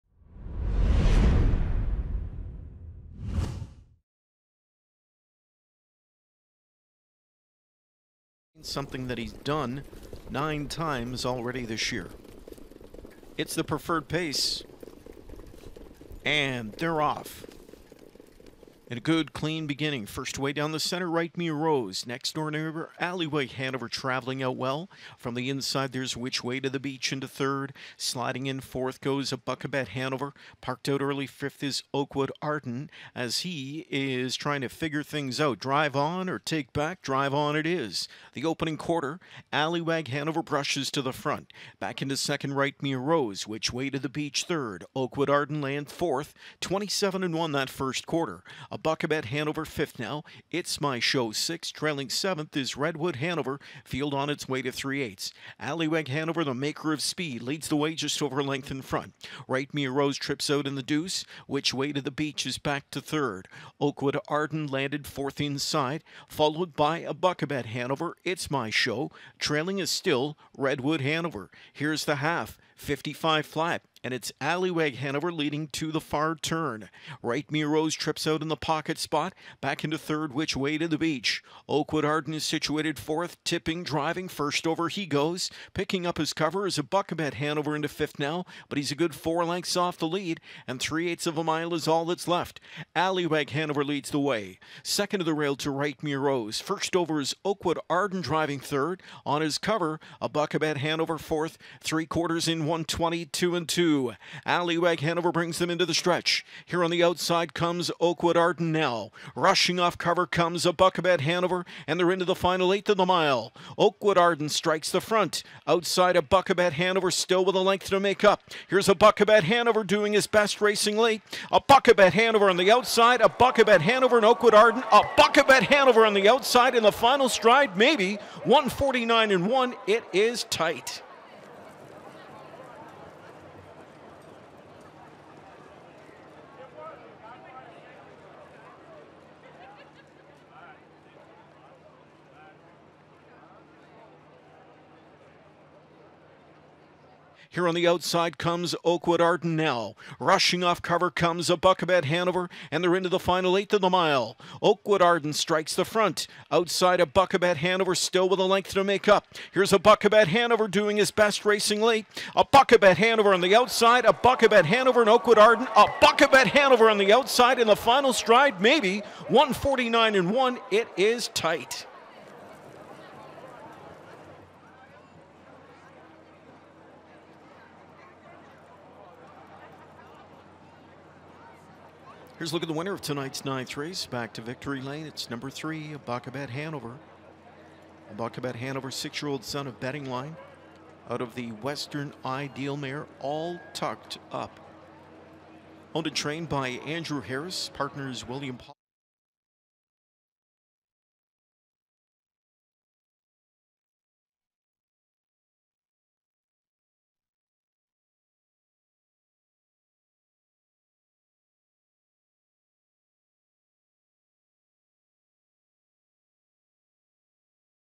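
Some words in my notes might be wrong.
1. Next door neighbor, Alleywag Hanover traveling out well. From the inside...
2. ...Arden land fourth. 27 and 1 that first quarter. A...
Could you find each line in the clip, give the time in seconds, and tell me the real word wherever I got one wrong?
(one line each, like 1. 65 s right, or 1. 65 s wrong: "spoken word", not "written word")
1. 22 s right
2. 45 s right.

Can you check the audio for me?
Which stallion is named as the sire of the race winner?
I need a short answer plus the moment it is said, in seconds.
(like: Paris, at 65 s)
Betting Line, at 189 s.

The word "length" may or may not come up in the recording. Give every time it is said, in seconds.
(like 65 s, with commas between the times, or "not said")
58 s, 89 s, 117 s, 158 s.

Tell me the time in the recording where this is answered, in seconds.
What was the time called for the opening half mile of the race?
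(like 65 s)
72 s.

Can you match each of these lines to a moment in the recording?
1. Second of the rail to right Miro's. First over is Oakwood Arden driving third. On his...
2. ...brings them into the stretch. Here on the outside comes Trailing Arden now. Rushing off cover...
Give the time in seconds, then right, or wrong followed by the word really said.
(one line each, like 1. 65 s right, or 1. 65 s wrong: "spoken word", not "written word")
1. 94 s right
2. 105 s wrong: "Oakwood", not "Trailing".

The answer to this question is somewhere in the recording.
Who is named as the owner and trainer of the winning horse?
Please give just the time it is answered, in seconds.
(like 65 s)
196 s.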